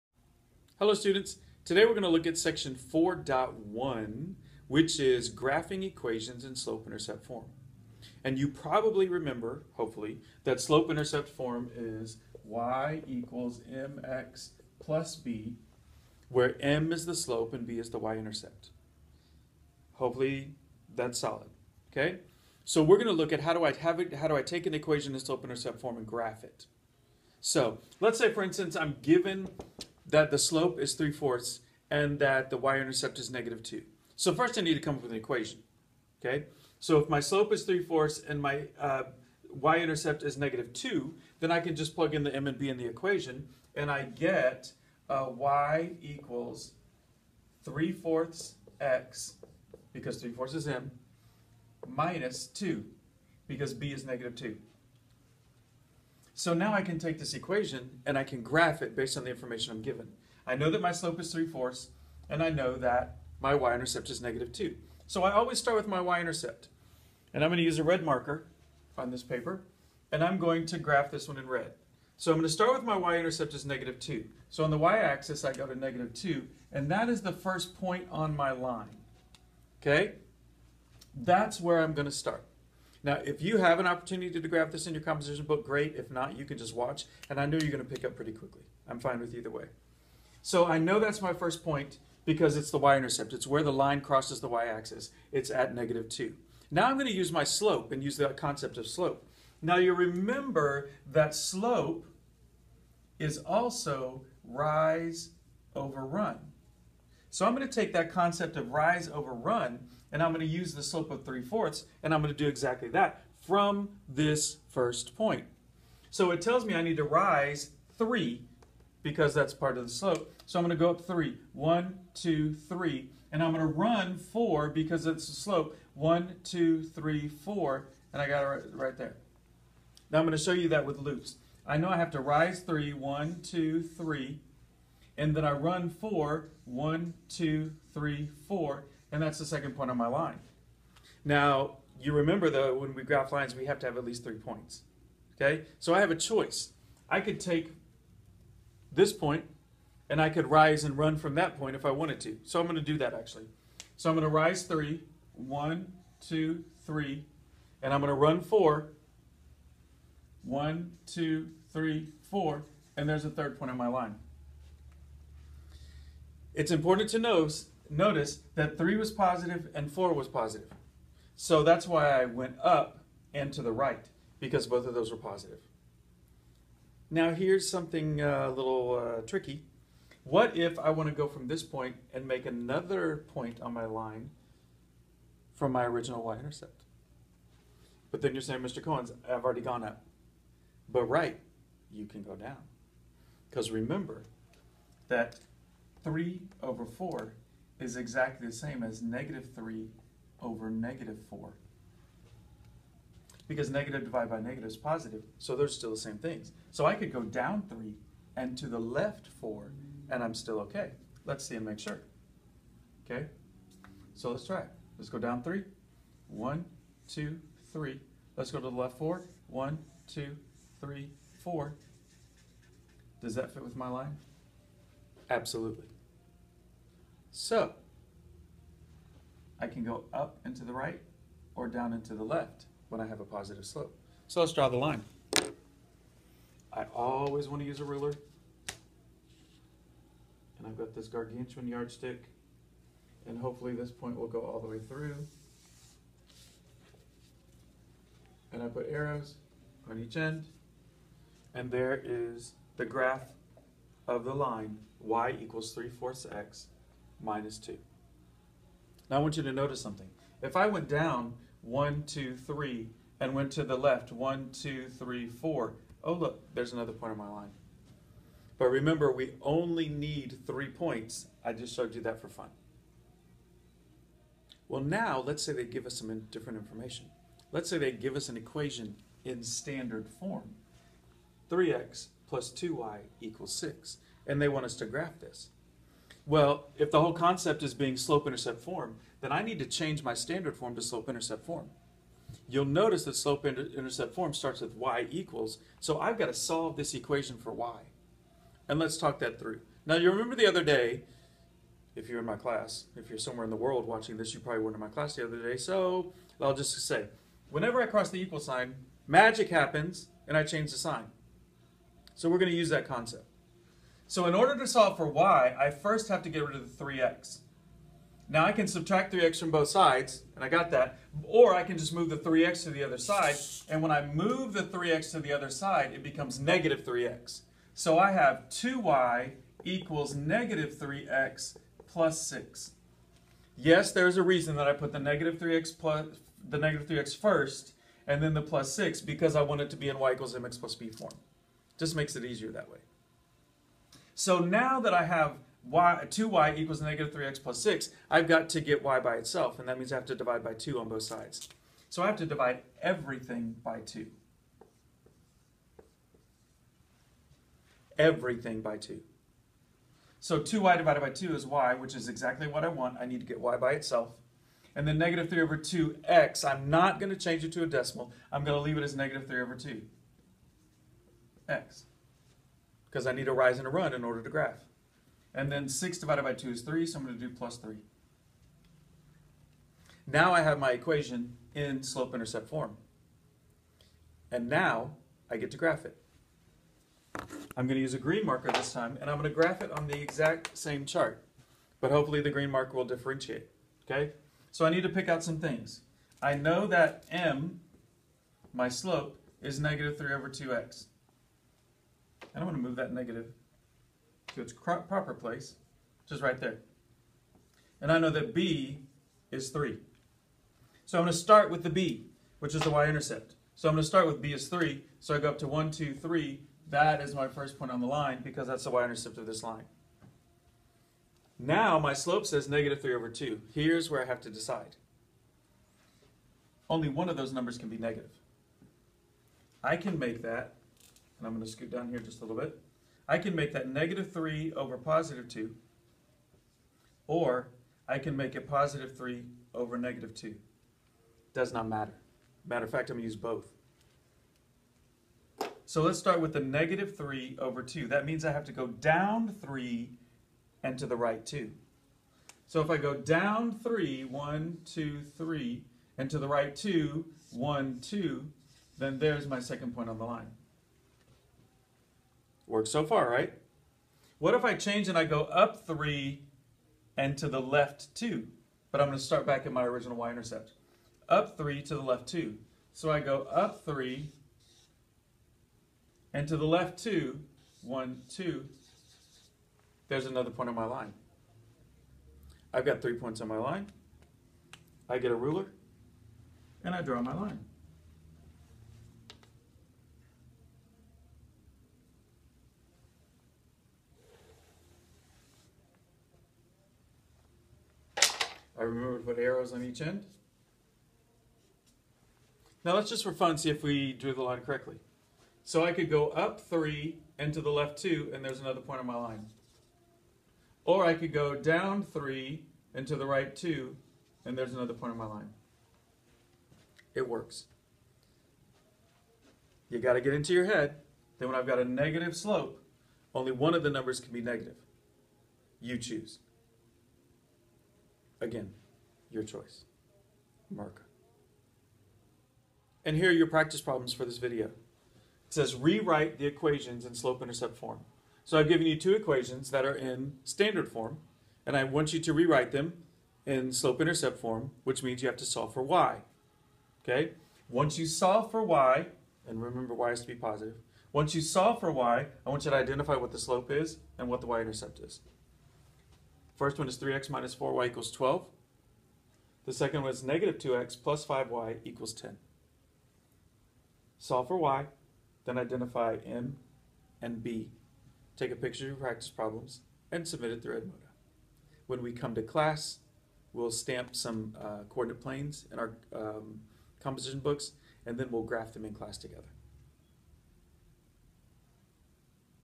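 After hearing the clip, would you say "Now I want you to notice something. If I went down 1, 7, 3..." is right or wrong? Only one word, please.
wrong.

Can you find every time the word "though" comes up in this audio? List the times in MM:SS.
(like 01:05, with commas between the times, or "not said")
02:22.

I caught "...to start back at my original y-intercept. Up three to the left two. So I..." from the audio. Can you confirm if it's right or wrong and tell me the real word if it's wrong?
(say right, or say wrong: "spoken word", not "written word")
right.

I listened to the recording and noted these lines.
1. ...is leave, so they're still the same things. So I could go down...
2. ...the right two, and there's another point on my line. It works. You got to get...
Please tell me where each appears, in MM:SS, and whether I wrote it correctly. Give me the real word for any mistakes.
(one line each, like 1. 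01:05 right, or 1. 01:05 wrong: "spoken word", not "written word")
1. 03:24 wrong: "positive", not "leave"
2. 08:32 right.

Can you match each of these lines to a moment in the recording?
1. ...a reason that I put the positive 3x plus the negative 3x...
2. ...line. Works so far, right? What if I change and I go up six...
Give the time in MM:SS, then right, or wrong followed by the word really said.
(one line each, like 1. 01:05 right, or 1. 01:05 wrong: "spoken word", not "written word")
1. 05:34 wrong: "negative", not "positive"
2. 07:40 wrong: "three", not "six".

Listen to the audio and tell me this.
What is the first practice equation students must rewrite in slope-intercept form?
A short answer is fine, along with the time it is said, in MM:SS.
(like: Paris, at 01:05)
3x - 4y = 12, at 09:16.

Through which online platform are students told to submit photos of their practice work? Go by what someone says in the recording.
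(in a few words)
Edmodo.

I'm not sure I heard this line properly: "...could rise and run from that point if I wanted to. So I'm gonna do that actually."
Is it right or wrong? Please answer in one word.
right.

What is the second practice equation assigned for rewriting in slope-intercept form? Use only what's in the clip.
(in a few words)
-2x + 5y = 10.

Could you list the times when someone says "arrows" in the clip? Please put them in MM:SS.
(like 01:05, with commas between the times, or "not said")
04:08, 08:19.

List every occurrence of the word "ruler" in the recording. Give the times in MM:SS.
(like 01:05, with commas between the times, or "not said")
03:57, 08:05.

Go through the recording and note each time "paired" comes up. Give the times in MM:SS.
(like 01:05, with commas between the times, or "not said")
not said.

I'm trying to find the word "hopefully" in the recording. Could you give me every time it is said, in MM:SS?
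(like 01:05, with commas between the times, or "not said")
00:09, 00:19, 04:03, 06:31.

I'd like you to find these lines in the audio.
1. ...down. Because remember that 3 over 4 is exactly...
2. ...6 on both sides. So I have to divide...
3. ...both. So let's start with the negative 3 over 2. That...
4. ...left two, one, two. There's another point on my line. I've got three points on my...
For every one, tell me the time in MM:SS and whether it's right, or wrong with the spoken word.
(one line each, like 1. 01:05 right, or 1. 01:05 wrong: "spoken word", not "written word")
1. 03:12 right
2. 05:50 wrong: "2", not "6"
3. 07:23 right
4. 07:56 right.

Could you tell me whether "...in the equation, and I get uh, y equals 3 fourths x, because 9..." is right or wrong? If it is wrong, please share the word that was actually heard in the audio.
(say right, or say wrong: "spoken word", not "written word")
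wrong: "3", not "9".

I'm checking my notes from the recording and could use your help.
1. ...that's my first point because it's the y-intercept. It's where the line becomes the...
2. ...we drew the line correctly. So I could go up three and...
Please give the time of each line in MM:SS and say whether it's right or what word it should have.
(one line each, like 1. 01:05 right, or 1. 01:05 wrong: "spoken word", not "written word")
1. 01:30 wrong: "crosses", not "becomes"
2. 08:23 right.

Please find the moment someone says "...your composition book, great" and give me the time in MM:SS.
01:24.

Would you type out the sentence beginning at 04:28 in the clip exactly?
But remember, we only need three points.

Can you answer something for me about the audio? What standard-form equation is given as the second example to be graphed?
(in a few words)
3x + 2y = 6.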